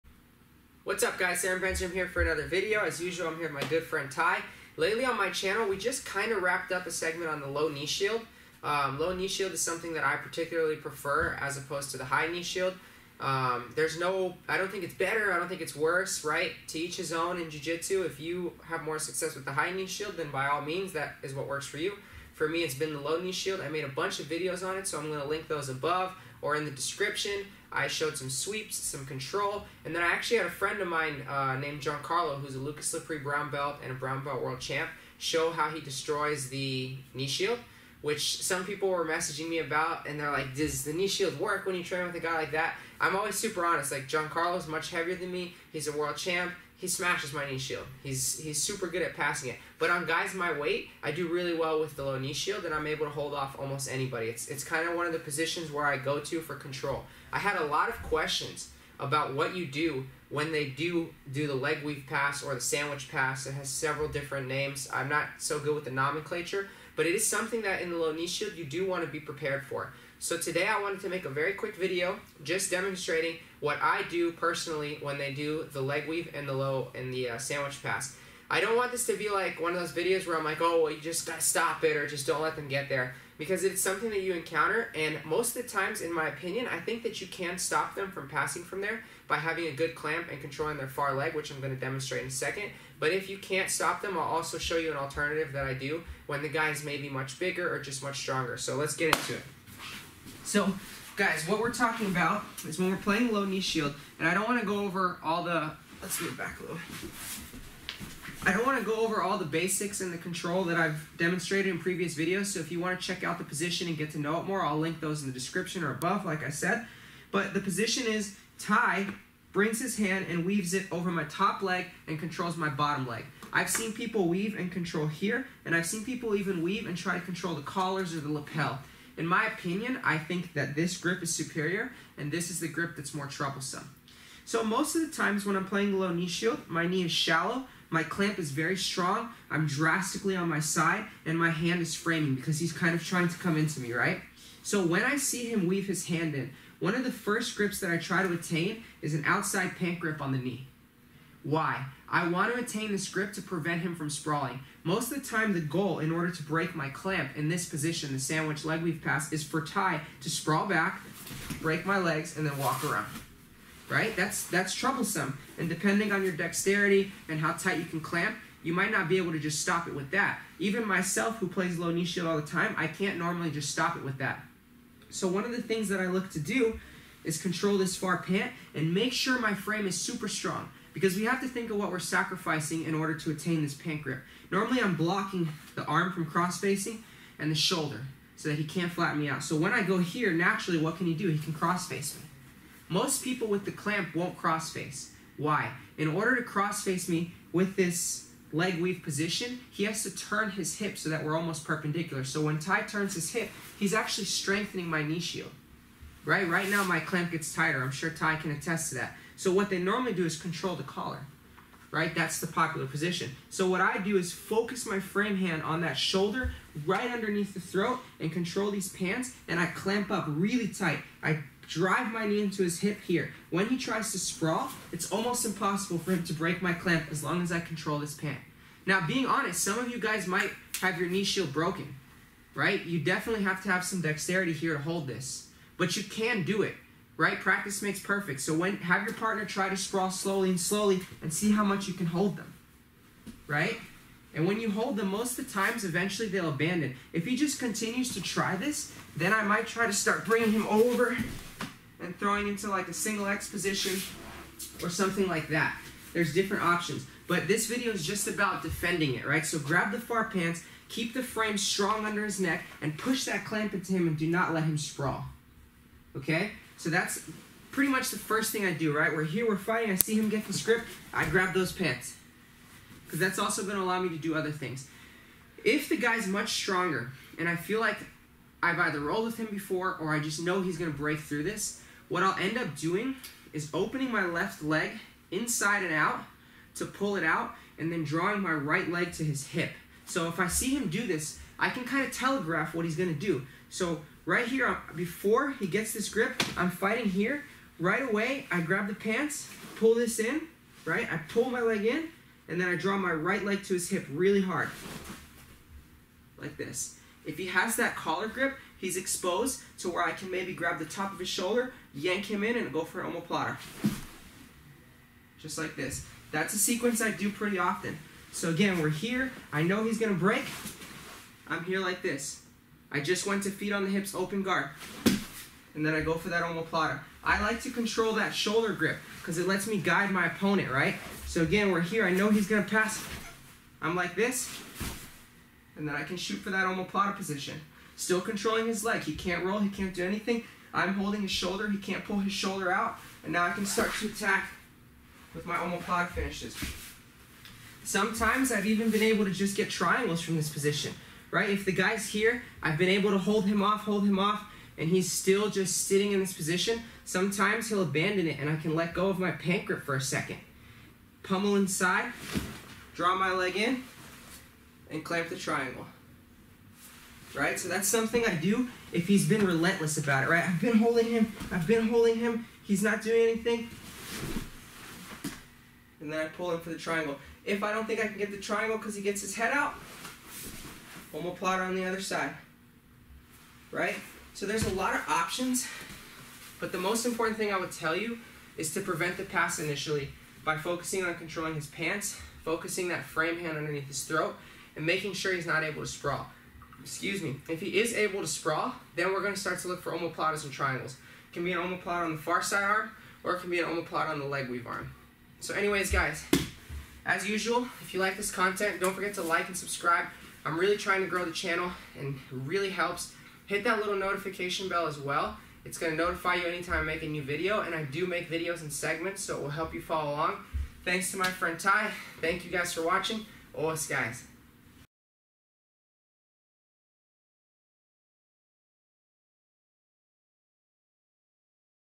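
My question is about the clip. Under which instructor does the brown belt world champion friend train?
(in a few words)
Lucas Lepri.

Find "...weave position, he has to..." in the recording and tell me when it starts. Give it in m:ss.
3:18.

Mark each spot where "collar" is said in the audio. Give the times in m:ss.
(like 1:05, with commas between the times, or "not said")
2:07, 3:30, 5:07.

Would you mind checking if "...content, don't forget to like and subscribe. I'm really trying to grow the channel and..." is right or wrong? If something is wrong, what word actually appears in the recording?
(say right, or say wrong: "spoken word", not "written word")
right.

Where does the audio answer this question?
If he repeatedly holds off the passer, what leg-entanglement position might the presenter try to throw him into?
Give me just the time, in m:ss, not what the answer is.
4:12.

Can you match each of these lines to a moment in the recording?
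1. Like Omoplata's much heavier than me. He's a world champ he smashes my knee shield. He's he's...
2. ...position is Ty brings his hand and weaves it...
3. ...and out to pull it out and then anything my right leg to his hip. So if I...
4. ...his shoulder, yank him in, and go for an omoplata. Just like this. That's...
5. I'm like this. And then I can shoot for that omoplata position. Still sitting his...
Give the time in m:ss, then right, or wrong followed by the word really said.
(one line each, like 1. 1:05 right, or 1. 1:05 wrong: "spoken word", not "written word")
1. 0:43 wrong: "Giancarlo", not "Omoplata"
2. 1:57 right
3. 4:45 wrong: "drawing", not "anything"
4. 5:11 right
5. 5:33 wrong: "controlling", not "sitting".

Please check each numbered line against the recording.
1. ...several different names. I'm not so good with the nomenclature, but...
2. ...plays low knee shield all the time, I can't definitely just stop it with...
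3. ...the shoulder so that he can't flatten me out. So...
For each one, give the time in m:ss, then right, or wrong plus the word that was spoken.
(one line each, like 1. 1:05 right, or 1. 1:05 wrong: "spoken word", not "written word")
1. 1:03 right
2. 2:51 wrong: "normally", not "definitely"
3. 3:07 right.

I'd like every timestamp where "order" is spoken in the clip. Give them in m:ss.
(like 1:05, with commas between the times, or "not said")
2:36, 3:02, 3:16.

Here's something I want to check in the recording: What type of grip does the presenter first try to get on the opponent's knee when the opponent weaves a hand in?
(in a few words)
outside pant grip.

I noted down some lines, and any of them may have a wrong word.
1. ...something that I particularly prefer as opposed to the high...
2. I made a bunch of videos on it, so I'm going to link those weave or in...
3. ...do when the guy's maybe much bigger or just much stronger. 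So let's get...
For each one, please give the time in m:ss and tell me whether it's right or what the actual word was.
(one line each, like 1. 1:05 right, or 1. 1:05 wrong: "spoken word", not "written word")
1. 0:09 right
2. 0:23 wrong: "above", not "weave"
3. 1:35 right.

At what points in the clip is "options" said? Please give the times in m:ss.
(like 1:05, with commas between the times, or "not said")
4:16, 6:25.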